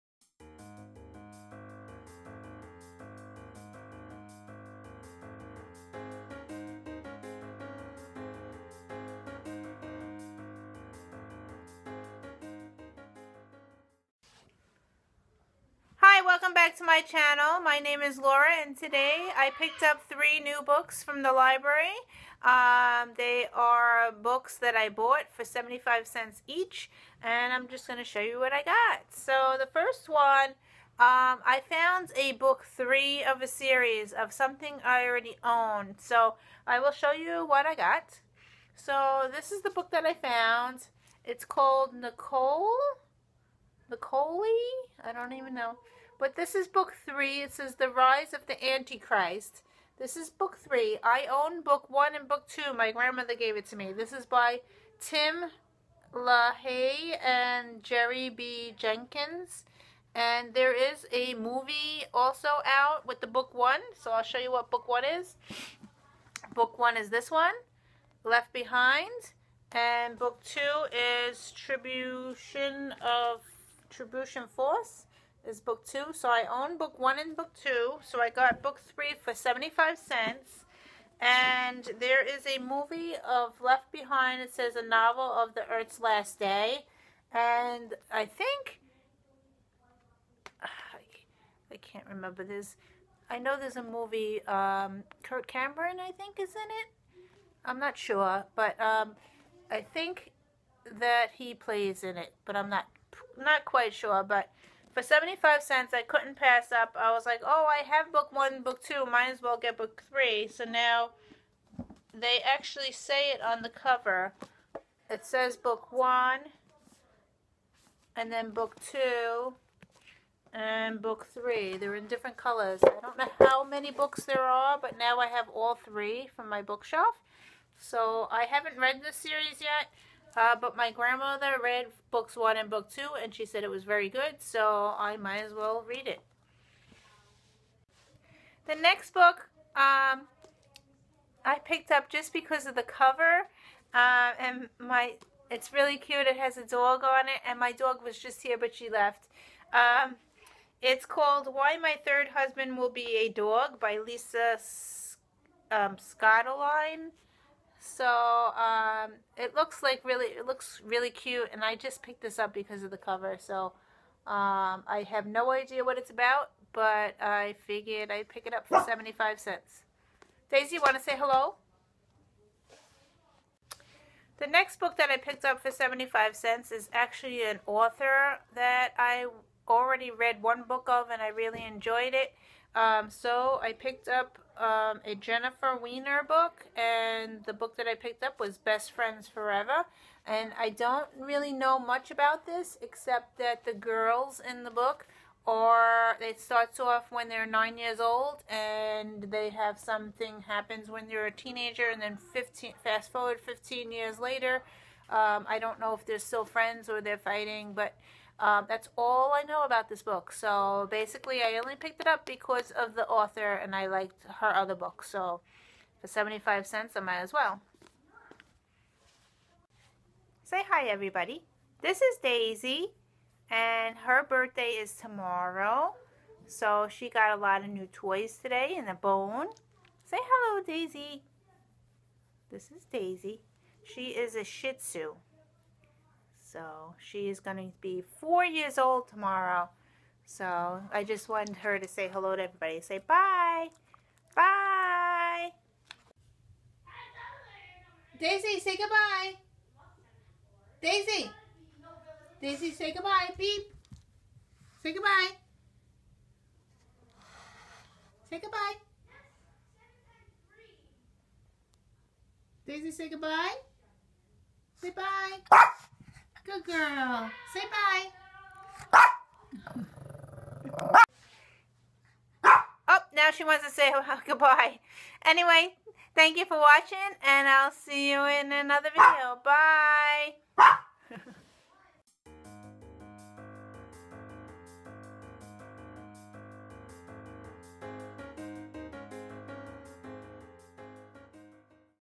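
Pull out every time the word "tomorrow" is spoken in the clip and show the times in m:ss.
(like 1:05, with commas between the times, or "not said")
3:44, 3:59.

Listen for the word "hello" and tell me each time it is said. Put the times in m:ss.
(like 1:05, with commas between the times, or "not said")
2:51, 3:50, 4:02.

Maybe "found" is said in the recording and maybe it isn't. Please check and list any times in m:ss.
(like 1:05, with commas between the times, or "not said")
0:31, 0:40.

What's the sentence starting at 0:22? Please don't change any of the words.
Um, they are books that I bought for 75 cents each and I'm just going to show you what I got.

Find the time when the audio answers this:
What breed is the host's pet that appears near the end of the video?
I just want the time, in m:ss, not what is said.
3:54.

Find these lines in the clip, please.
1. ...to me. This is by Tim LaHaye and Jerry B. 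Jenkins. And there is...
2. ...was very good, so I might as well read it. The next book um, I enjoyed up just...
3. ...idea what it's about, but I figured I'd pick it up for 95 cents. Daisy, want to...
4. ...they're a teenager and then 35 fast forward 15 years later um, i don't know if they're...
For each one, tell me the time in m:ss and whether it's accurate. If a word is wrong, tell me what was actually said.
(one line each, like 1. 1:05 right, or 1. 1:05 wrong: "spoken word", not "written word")
1. 0:53 right
2. 2:13 wrong: "picked", not "enjoyed"
3. 2:45 wrong: "75", not "95"
4. 3:21 wrong: "15", not "35".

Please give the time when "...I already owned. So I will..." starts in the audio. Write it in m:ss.
0:34.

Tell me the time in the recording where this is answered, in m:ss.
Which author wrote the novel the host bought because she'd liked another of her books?
3:05.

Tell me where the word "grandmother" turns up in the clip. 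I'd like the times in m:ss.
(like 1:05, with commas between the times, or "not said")
0:52, 2:10.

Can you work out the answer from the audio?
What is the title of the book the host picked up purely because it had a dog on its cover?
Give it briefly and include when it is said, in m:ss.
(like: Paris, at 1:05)
Why My Third Husband Will Be a Dog, at 2:31.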